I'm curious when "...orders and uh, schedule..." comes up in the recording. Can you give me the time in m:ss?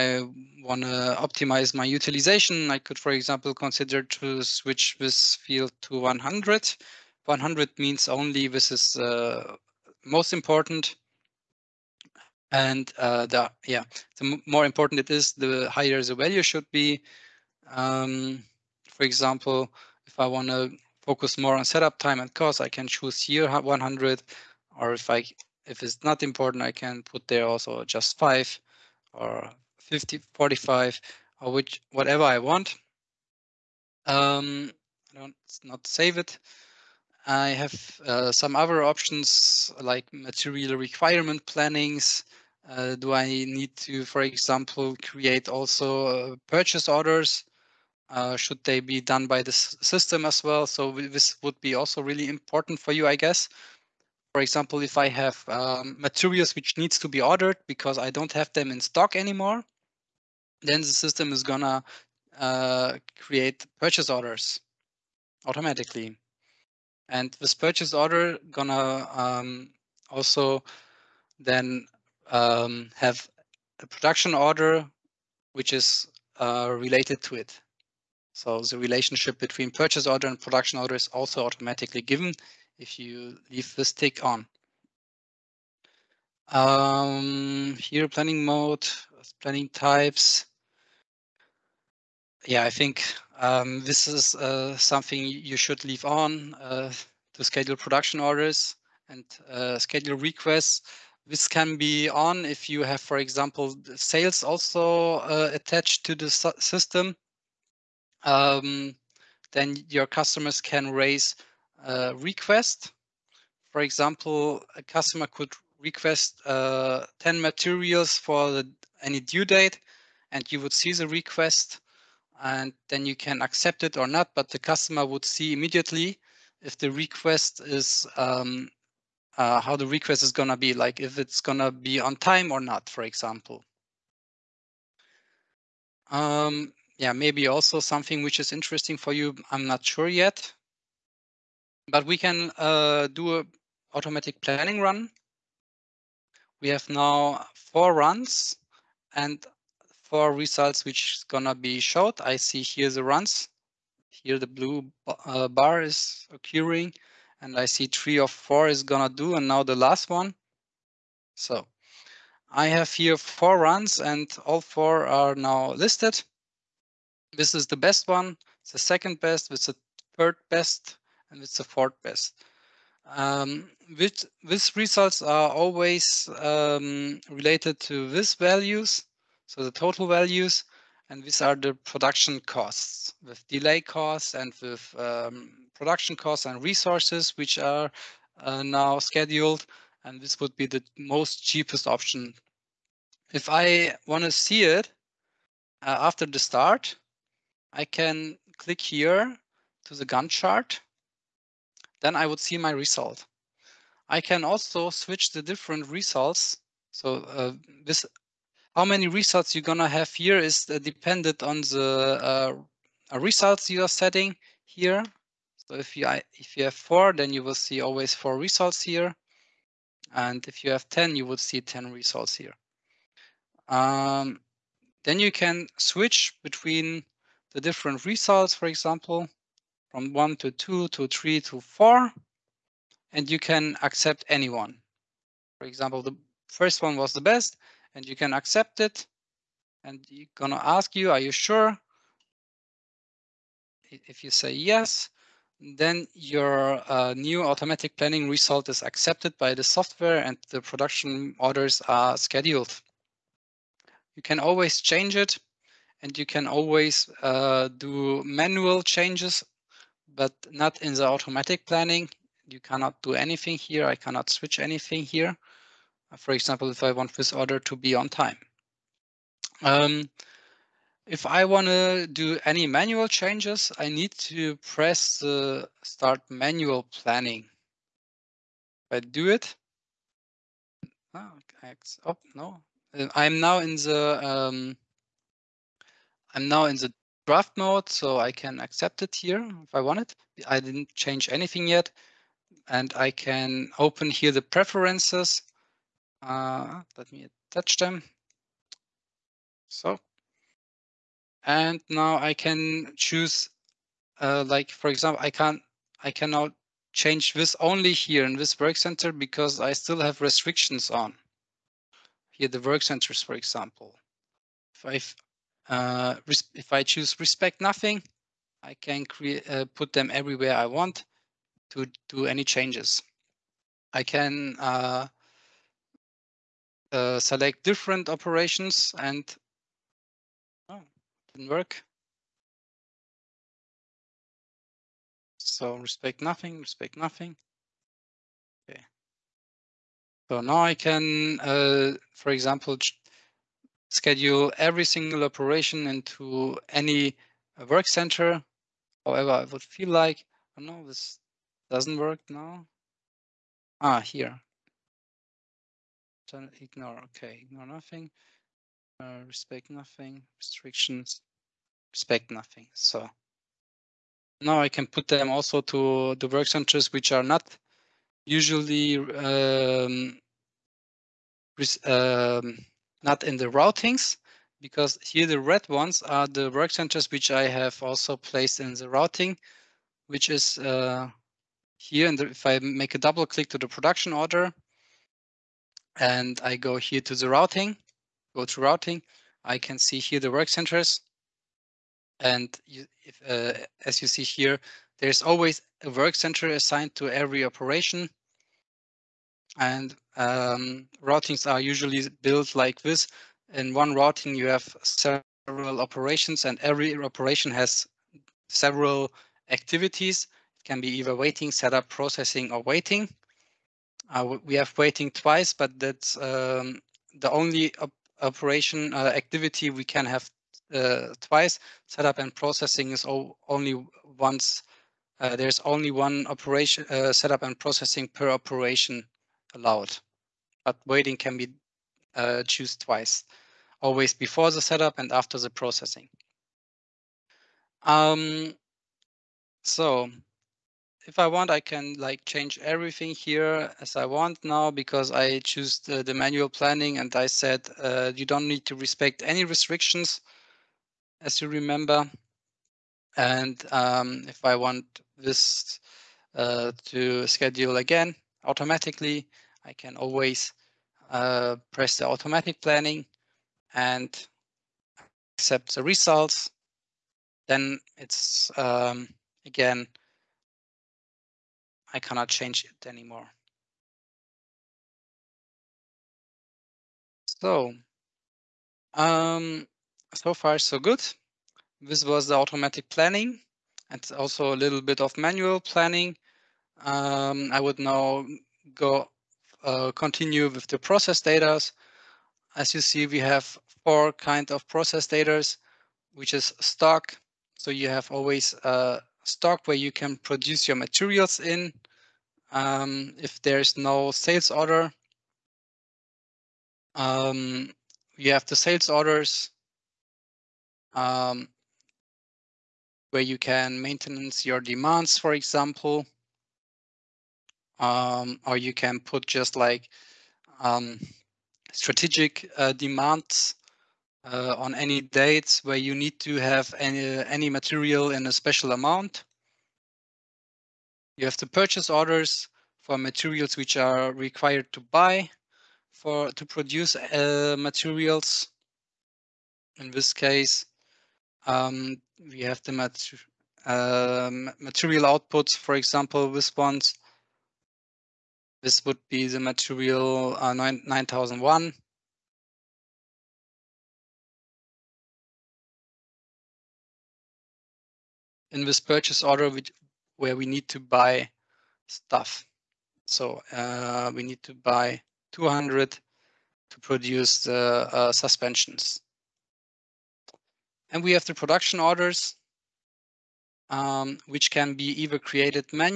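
1:38.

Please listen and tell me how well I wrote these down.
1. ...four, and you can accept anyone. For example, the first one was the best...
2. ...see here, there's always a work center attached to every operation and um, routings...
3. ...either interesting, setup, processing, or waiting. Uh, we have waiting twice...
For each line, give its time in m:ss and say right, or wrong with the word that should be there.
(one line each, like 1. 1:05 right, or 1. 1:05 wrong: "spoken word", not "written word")
1. 3:51 right
2. 6:34 wrong: "assigned", not "attached"
3. 6:50 wrong: "waiting", not "interesting".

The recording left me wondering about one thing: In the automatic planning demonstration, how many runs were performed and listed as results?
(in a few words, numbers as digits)
4.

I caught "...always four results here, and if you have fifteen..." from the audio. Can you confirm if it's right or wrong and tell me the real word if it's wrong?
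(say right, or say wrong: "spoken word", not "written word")
wrong: "ten", not "fifteen".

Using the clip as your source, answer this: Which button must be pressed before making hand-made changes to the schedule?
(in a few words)
Start manual planning.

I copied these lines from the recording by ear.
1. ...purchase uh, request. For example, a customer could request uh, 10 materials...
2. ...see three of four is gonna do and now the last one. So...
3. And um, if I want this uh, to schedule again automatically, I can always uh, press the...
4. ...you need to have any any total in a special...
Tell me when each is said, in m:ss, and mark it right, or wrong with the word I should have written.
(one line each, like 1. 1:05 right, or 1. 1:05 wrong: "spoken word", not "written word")
1. 1:50 wrong: "raise", not "purchase"
2. 2:37 right
3. 7:33 right
4. 8:45 wrong: "material", not "total".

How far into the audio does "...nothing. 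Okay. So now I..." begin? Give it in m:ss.
5:36.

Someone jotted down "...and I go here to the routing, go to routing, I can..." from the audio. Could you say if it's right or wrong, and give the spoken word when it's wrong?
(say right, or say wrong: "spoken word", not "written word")
right.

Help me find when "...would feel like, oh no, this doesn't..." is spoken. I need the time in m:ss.
5:49.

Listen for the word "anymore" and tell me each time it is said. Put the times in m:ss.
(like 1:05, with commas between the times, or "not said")
0:59, 7:52.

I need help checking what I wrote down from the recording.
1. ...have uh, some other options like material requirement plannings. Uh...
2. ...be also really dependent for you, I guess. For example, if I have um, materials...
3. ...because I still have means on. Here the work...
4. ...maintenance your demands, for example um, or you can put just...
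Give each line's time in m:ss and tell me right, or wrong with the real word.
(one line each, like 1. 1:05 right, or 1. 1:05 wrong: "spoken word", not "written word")
1. 0:37 right
2. 0:51 wrong: "important", not "dependent"
3. 5:09 wrong: "restrictions", not "means"
4. 8:33 right.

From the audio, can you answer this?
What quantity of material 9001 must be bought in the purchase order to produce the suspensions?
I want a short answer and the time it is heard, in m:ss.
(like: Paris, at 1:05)
200, at 9:24.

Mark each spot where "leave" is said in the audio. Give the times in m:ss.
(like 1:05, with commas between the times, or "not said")
1:23, 1:35.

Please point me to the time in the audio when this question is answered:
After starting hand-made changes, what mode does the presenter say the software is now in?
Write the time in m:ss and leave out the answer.
4:47.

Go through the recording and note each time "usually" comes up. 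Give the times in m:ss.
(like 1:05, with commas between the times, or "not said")
6:08, 6:41.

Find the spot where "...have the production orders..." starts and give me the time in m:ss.
9:31.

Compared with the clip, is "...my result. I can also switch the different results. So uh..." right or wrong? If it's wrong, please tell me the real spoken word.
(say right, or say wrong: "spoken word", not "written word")
right.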